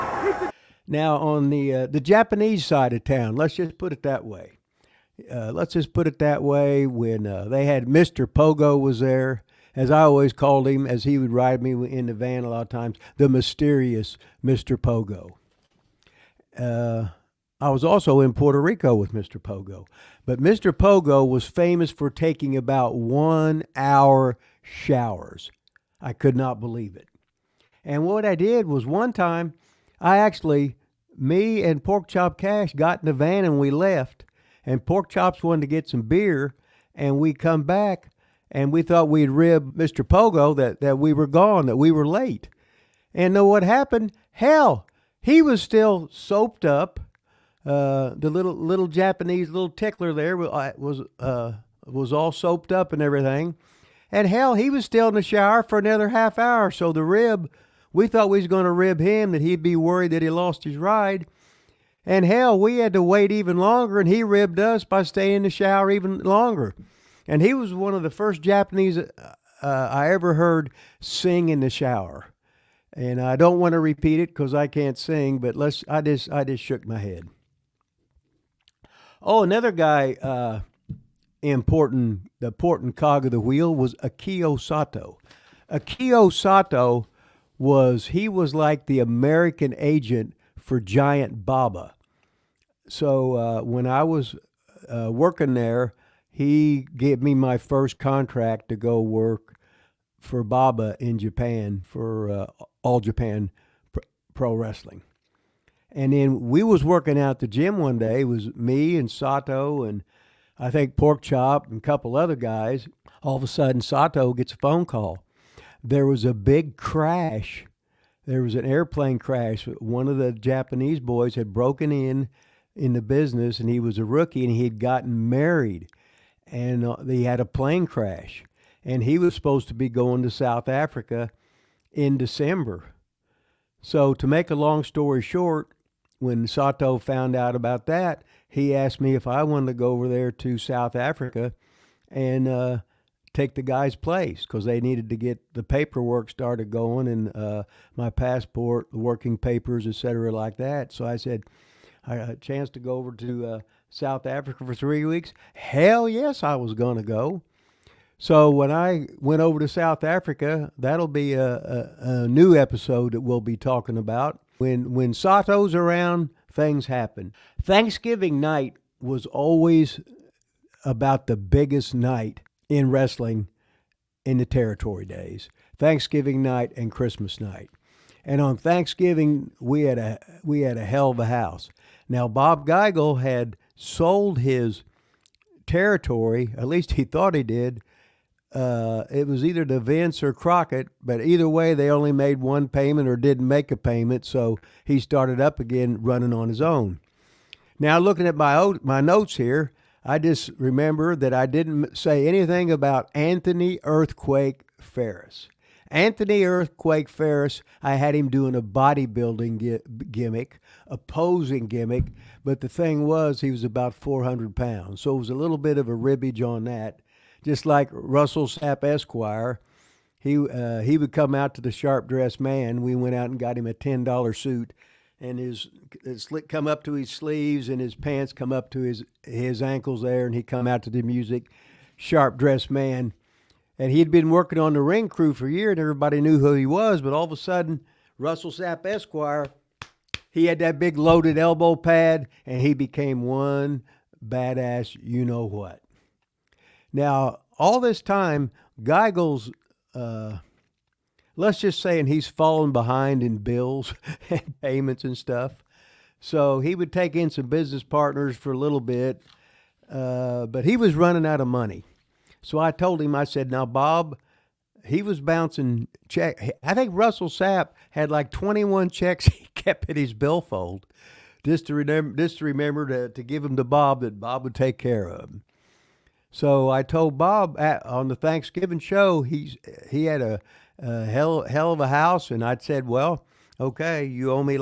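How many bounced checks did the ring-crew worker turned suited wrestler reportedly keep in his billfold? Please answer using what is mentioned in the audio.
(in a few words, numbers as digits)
21.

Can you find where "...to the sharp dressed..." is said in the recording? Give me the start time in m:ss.
3:41.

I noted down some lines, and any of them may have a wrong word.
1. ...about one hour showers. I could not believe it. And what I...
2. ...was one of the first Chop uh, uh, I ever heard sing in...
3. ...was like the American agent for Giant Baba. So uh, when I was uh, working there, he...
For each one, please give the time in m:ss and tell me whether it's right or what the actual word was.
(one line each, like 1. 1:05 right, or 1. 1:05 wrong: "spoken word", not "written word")
1. 0:22 right
2. 1:07 wrong: "Japanese", not "Chop"
3. 1:28 right.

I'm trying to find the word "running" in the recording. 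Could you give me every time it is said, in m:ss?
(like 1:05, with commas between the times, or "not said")
3:16, 4:20.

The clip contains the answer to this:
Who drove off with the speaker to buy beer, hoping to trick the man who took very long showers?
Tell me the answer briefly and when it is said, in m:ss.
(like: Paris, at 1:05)
Pork Chop Cash, at 0:31.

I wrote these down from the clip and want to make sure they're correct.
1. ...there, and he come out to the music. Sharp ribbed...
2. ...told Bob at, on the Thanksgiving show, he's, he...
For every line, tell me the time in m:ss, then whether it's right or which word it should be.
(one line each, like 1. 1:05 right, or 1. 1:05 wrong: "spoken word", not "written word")
1. 3:50 wrong: "dressed", not "ribbed"
2. 4:36 right.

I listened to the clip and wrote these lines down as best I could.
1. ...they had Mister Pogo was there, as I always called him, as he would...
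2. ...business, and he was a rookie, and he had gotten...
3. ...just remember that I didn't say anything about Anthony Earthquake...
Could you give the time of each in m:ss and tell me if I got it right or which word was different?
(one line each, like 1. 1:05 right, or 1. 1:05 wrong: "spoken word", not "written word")
1. 0:07 right
2. 2:03 right
3. 3:20 right.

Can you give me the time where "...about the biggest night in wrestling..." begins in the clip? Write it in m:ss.
2:50.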